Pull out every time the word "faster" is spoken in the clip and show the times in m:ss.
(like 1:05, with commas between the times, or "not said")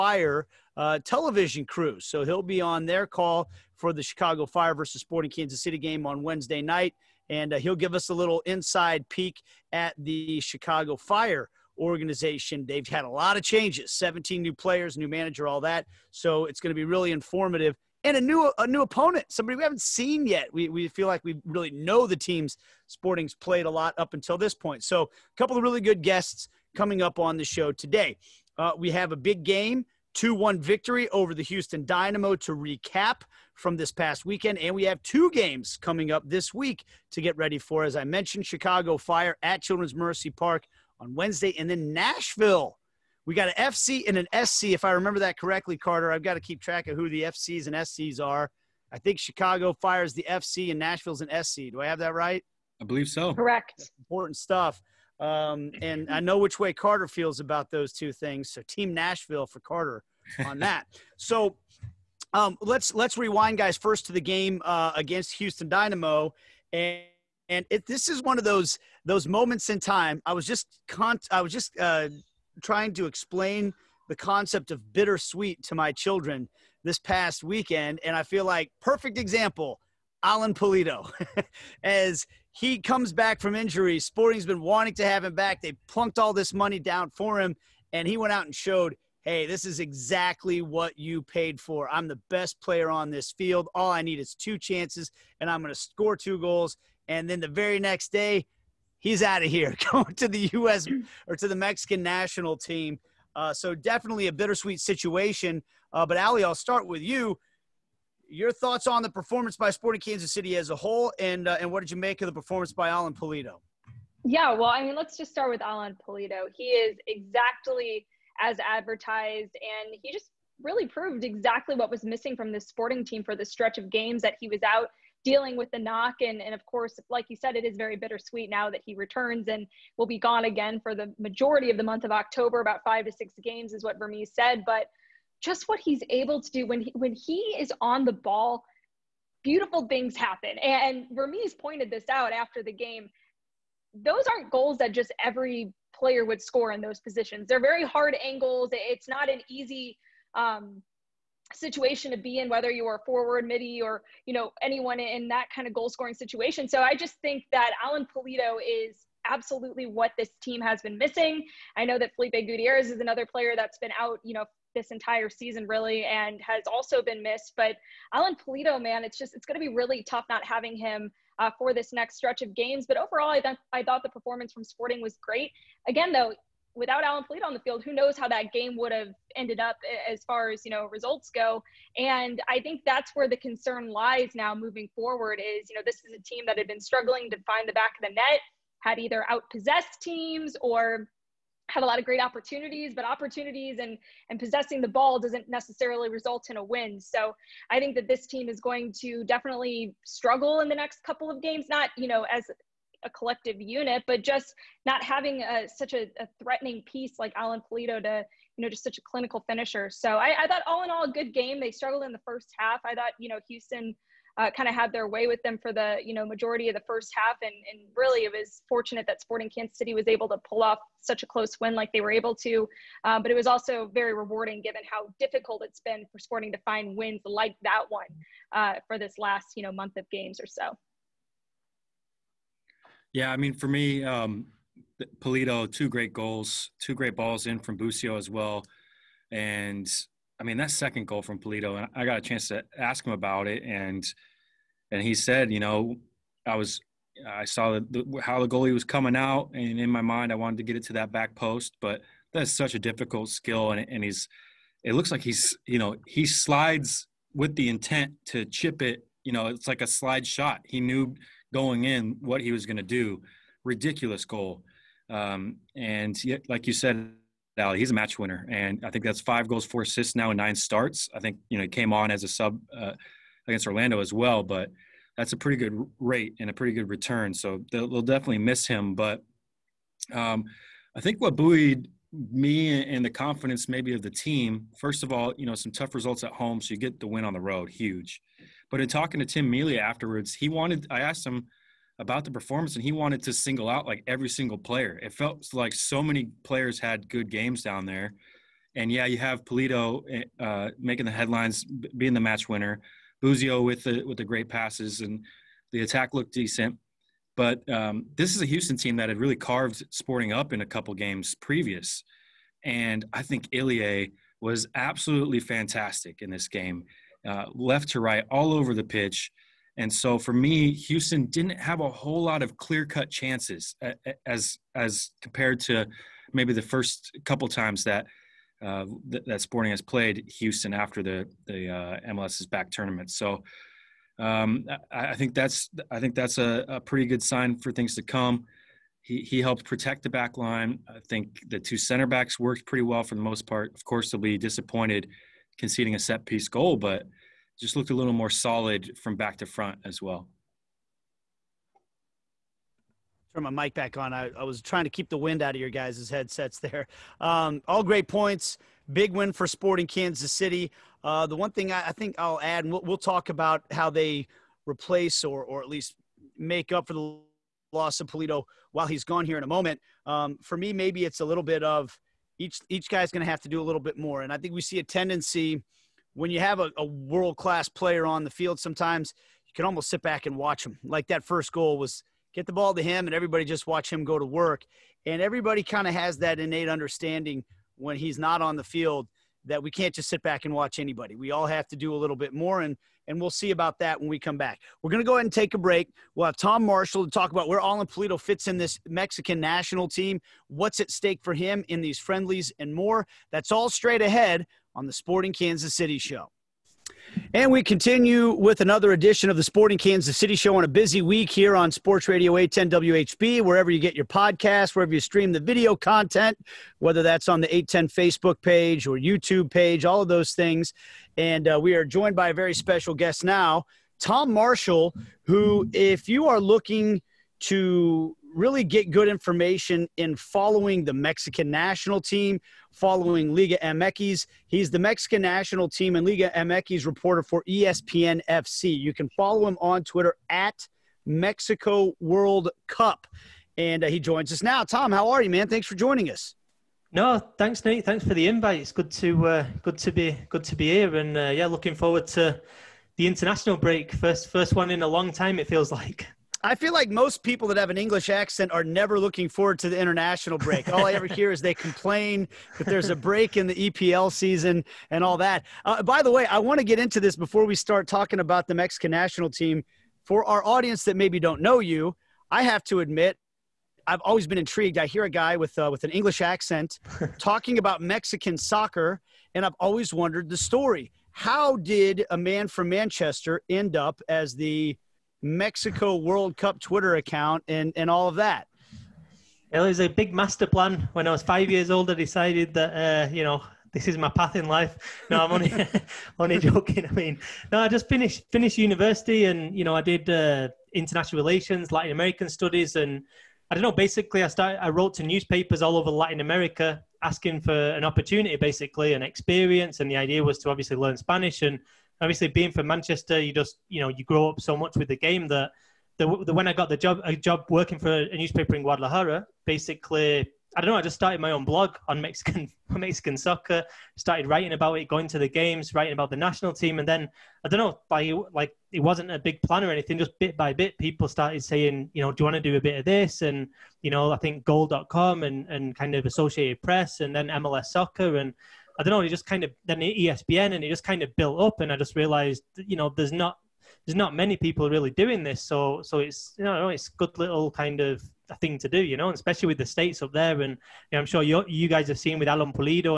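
not said.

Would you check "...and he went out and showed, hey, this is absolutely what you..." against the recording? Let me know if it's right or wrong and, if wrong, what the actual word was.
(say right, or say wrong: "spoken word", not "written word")
wrong: "exactly", not "absolutely".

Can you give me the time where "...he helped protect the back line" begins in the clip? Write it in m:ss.
5:39.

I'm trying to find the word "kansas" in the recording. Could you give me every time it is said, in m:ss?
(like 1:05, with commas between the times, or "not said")
0:05, 1:49, 3:39, 5:59, 6:45, 6:49.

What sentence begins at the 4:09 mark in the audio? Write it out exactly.
And in my mind, I wanted to get it to that back post, but that's such a difficult skill.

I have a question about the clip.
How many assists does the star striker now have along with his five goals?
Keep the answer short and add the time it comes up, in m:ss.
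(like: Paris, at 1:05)
4, at 4:29.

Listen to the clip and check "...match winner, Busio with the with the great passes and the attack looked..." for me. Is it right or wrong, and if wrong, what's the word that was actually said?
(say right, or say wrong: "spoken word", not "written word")
right.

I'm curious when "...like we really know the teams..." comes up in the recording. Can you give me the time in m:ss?
0:21.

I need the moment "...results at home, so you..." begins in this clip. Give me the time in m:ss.
4:45.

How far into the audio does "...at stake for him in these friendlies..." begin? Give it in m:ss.
6:40.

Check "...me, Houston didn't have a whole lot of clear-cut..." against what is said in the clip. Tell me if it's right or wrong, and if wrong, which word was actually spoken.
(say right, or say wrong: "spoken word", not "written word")
right.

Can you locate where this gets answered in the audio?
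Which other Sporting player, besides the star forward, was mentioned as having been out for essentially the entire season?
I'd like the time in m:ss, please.
2:42.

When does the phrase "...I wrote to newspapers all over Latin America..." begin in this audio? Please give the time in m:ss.
8:24.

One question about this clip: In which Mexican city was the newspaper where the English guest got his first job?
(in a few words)
Guadalajara.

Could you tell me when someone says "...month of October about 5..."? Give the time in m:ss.
2:11.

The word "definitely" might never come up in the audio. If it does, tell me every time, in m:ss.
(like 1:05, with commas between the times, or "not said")
1:43, 3:19, 4:38.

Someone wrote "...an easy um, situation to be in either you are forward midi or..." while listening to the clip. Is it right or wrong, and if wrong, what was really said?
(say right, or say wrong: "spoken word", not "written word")
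wrong: "whether", not "either".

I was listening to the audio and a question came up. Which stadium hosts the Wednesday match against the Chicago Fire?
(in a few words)
Children's Mercy Park.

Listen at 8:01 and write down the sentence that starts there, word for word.
How did a man from Manchester end up as the Mexico World Cup Twitter account and, and all of that?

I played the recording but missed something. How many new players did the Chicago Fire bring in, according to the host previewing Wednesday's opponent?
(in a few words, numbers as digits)
17.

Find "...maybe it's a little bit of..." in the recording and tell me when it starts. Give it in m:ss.
6:10.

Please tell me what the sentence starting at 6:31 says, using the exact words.
We all have to do a little bit more, and and we'll see about that when we come back.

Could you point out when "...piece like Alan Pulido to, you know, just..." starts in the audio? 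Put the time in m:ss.
3:26.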